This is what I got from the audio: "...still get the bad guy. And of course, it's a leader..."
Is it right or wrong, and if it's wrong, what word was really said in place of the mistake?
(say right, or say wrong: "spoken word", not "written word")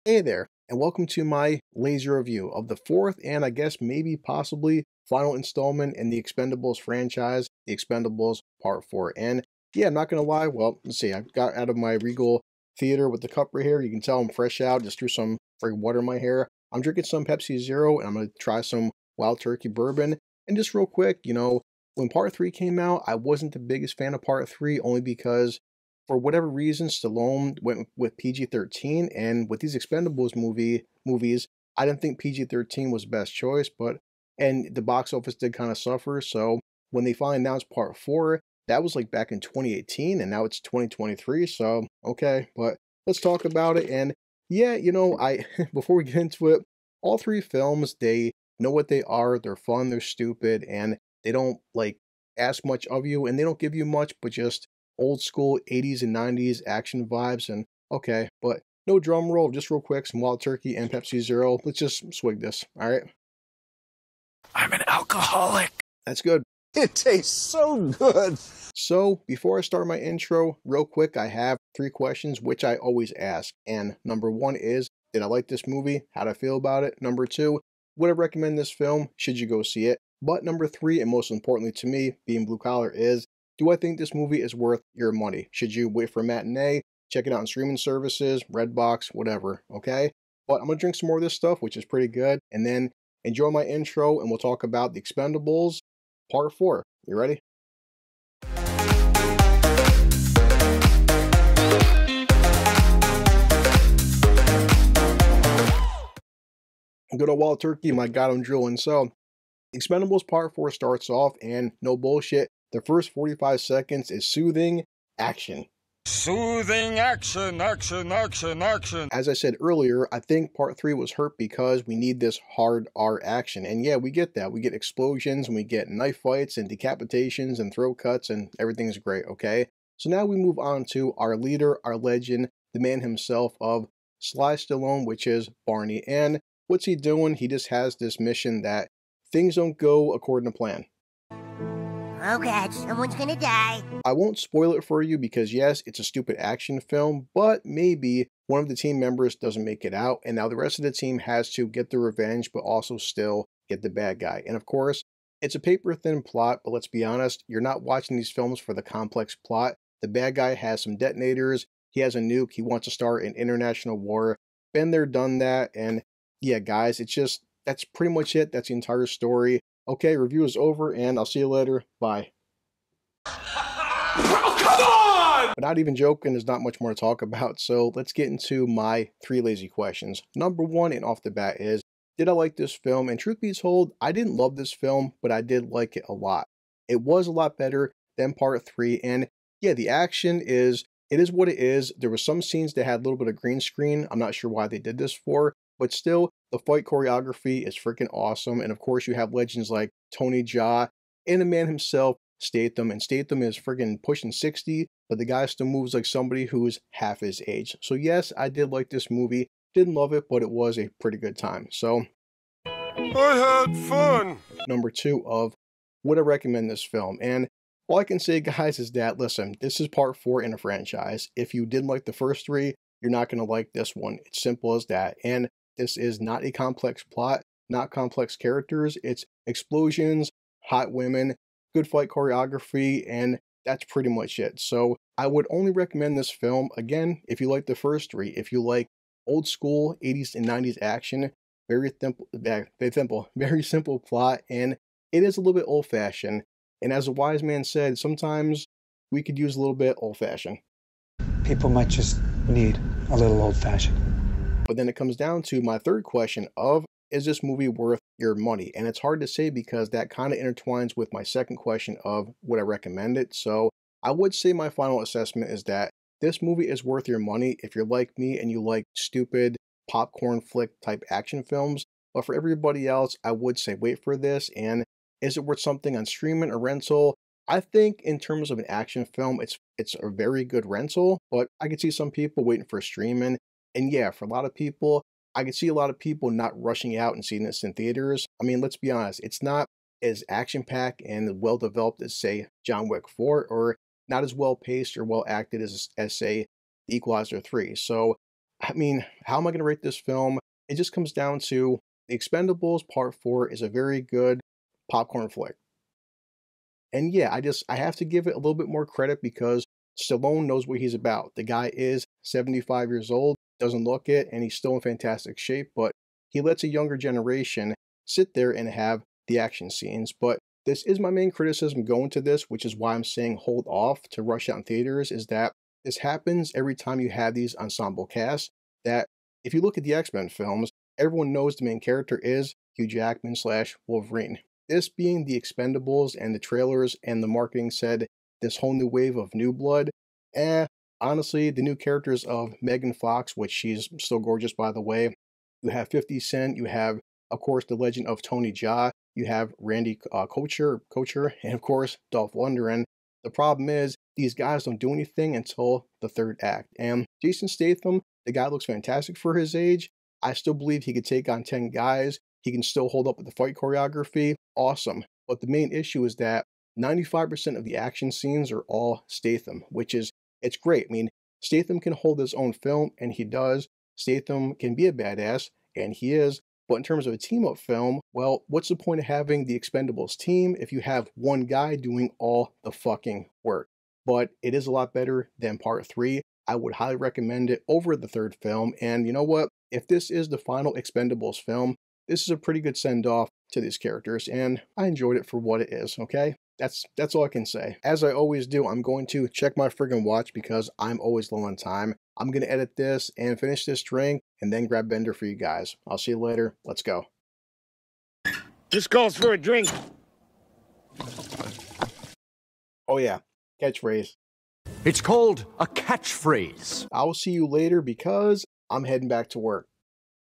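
wrong: "paper", not "leader".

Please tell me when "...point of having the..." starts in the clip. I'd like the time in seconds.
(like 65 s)
378 s.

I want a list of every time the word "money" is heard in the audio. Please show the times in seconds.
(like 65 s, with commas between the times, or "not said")
85 s, 258 s, 267 s.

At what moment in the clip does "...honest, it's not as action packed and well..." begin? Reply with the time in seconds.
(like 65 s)
288 s.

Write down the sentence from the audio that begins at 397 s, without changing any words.
As I always do, I'm going to check my friggin' watch because I'm always low on time.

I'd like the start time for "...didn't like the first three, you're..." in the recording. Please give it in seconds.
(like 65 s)
221 s.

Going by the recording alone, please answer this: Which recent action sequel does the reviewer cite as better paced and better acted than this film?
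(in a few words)
The Equalizer 3.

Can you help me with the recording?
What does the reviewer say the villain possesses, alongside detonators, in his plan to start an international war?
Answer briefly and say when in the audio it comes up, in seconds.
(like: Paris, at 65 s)
A nuke, at 162 s.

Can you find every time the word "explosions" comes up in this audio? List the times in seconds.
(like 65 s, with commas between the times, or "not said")
124 s, 229 s.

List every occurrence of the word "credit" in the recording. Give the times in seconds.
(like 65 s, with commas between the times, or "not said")
308 s.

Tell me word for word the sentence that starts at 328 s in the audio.
That if you look at the X Men films, everyone knows the main character is Hugh Jackman slash Wolverine.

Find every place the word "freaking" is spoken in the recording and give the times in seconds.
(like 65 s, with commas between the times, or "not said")
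15 s, 197 s, 203 s.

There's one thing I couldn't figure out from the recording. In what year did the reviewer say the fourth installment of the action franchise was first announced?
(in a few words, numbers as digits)
2018.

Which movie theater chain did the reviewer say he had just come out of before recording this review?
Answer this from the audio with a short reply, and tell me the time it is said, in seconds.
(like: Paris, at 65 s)
Regal, at 12 s.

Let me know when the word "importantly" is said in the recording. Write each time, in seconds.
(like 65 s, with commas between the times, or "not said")
81 s.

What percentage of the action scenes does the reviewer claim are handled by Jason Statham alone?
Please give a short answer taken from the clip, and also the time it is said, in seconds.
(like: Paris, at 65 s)
95%, at 366 s.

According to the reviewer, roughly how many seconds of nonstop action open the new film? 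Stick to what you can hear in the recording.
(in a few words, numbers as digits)
45.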